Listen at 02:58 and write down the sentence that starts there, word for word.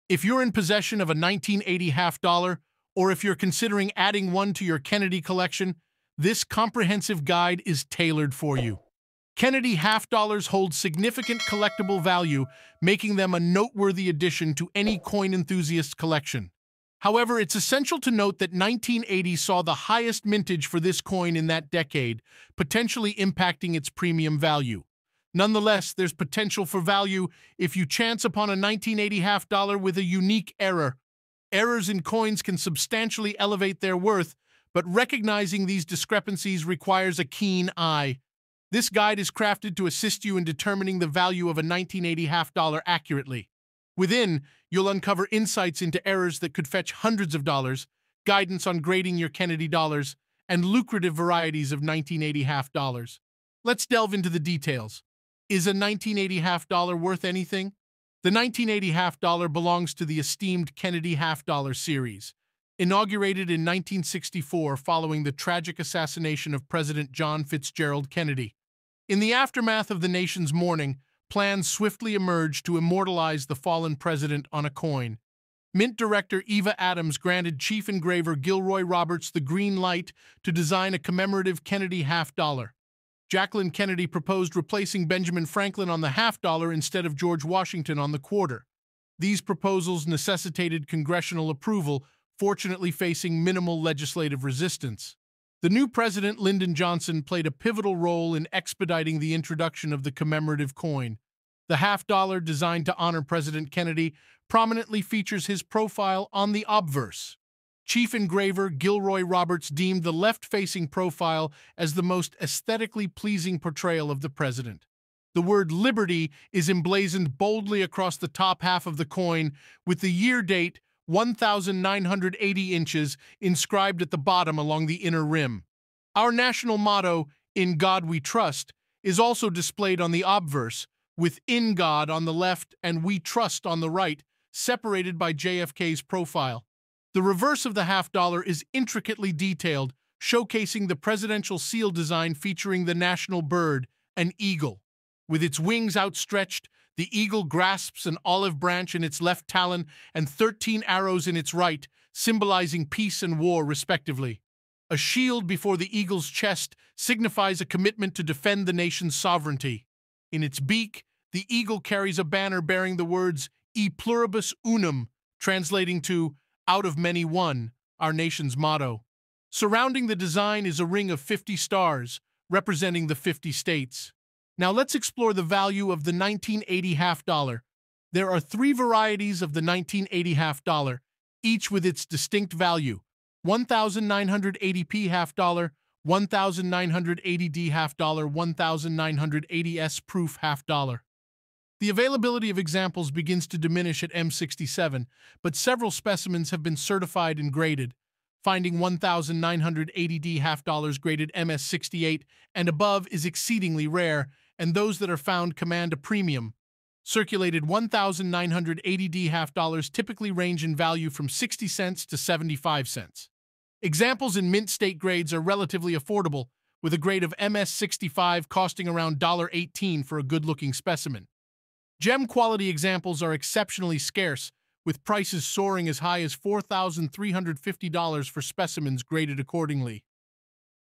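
There are three varieties of the 1980 half dollar, each with its distinct value.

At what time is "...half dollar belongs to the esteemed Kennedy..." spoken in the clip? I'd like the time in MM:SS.
00:58.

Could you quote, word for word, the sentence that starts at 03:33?
Examples in mint state grades are relatively affordable, with a grade of MS65 costing around $1.18 for a good-looking specimen.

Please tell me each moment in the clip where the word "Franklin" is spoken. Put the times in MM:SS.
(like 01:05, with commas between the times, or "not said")
01:25.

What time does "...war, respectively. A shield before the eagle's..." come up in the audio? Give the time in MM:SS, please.
02:33.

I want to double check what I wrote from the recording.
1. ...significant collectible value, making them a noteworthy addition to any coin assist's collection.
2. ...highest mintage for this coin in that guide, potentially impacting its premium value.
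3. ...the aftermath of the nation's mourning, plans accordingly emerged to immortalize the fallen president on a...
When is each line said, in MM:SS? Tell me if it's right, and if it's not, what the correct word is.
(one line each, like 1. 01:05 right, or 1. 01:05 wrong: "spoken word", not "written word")
1. 00:10 wrong: "enthusiast", not "assist"
2. 00:19 wrong: "decade", not "guide"
3. 01:09 wrong: "swiftly", not "accordingly".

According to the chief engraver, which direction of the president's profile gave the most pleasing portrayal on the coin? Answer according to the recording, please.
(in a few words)
left-facing.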